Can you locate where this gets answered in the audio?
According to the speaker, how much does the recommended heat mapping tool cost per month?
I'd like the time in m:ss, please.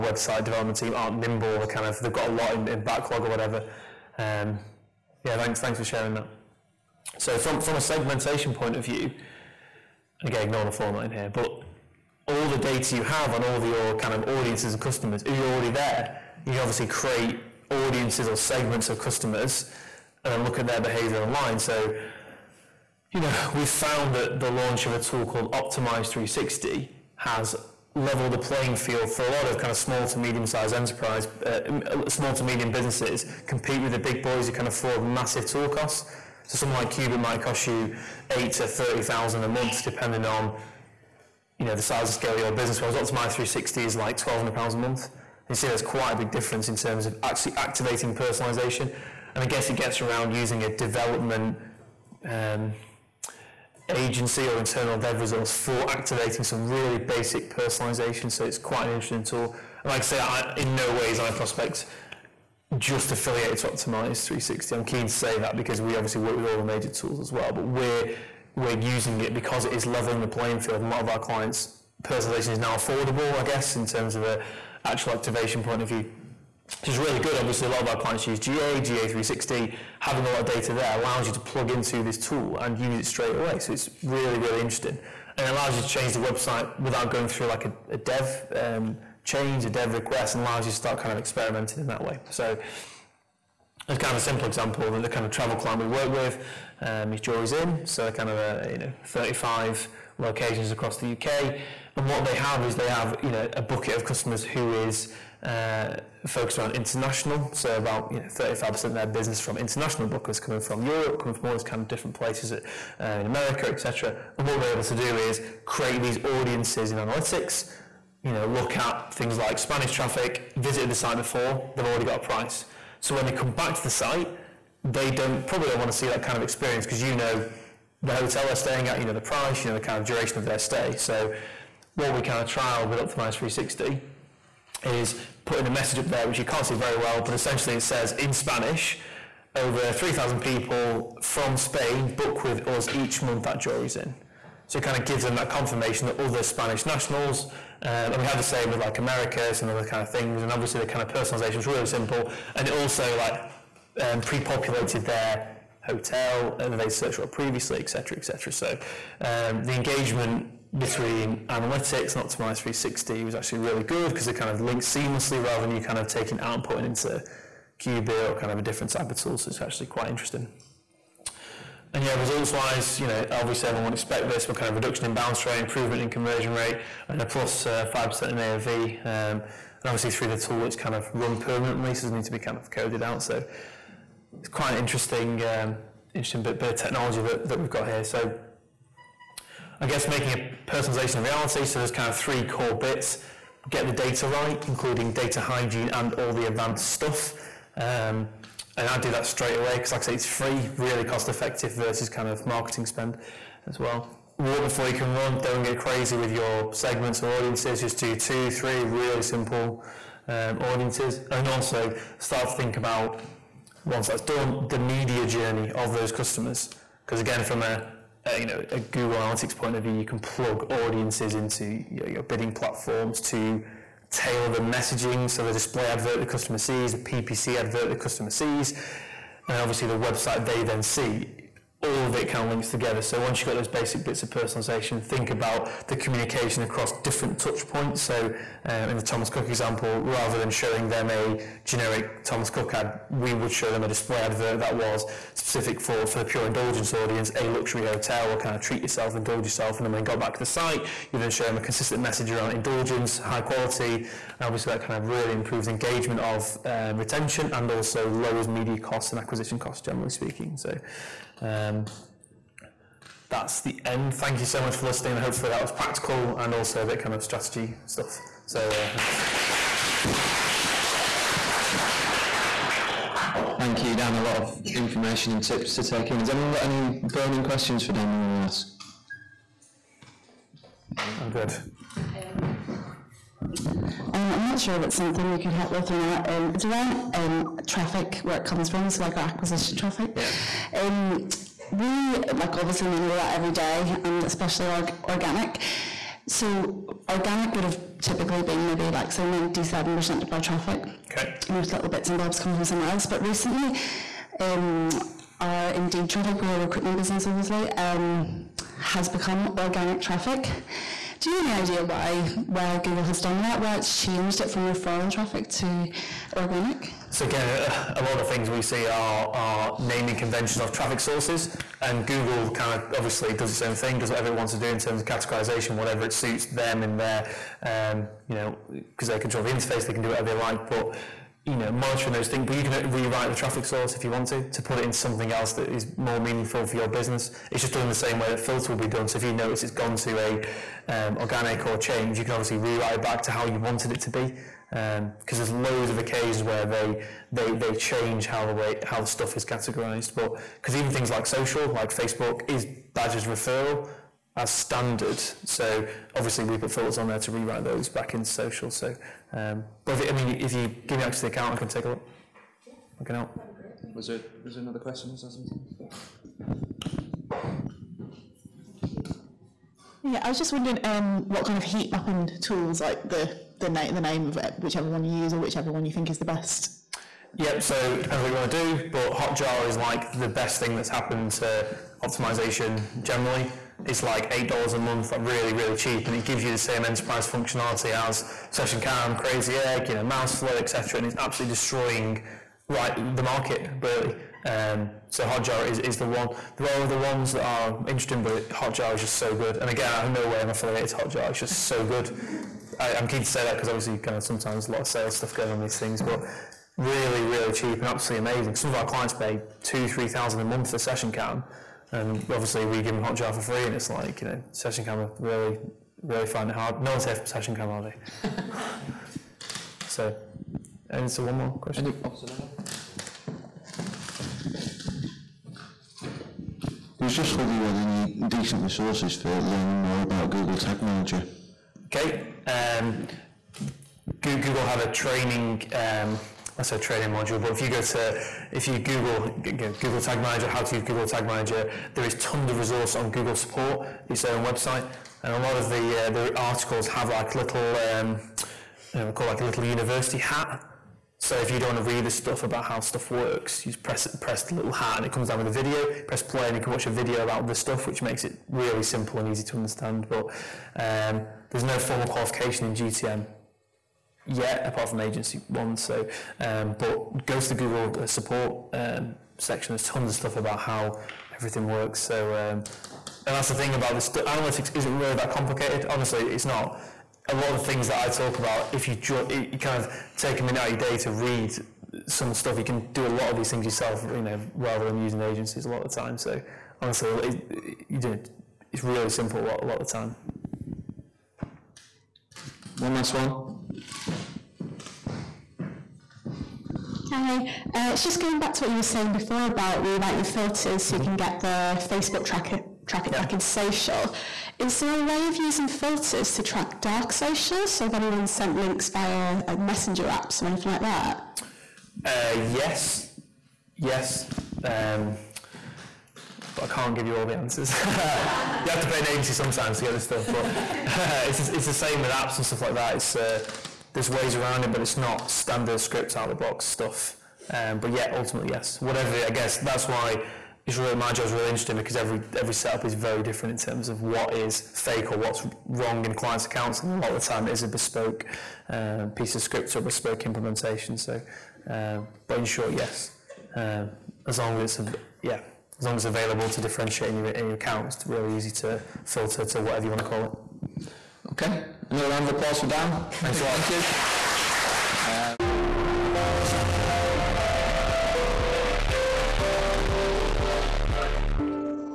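6:24.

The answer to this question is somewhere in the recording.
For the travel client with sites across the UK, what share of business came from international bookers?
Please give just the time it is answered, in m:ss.
1:48.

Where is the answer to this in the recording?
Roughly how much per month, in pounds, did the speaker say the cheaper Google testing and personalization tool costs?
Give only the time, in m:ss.
0:44.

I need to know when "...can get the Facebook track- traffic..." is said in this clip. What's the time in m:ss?
8:20.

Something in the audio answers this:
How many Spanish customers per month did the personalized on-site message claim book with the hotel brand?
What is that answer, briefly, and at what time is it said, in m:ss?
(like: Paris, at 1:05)
3,000, at 2:19.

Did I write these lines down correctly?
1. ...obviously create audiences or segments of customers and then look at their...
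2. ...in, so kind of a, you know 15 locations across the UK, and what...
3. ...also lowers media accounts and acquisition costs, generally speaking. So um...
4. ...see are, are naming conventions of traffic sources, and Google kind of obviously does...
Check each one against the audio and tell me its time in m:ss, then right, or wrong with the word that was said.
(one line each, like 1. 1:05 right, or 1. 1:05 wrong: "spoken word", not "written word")
1. 0:16 right
2. 1:37 wrong: "35", not "15"
3. 4:17 wrong: "costs", not "accounts"
4. 5:18 right.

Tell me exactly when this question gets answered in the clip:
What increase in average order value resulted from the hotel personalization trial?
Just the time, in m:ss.
2:57.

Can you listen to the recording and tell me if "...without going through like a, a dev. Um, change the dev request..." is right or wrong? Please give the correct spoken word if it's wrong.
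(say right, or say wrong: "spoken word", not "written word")
right.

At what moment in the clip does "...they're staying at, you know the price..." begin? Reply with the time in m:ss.
2:08.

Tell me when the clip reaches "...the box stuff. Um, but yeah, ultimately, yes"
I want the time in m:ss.
8:46.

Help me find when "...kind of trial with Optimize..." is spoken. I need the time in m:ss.
2:12.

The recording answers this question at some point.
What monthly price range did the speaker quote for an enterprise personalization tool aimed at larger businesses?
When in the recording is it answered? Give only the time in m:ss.
0:38.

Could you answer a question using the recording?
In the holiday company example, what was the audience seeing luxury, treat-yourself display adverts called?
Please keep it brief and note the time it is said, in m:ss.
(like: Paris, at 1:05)
pure indulgence, at 4:06.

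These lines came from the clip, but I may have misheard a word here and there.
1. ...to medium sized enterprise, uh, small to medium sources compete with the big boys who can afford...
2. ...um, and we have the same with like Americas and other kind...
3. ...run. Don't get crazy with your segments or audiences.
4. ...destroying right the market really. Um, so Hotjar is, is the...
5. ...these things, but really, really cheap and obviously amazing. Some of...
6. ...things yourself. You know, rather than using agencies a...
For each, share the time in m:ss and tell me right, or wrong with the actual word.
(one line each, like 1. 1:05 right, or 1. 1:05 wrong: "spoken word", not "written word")
1. 0:30 wrong: "businesses", not "sources"
2. 2:27 right
3. 3:25 right
4. 6:31 right
5. 6:45 wrong: "absolutely", not "obviously"
6. 8:03 right.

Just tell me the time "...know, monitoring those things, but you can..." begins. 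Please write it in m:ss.
5:31.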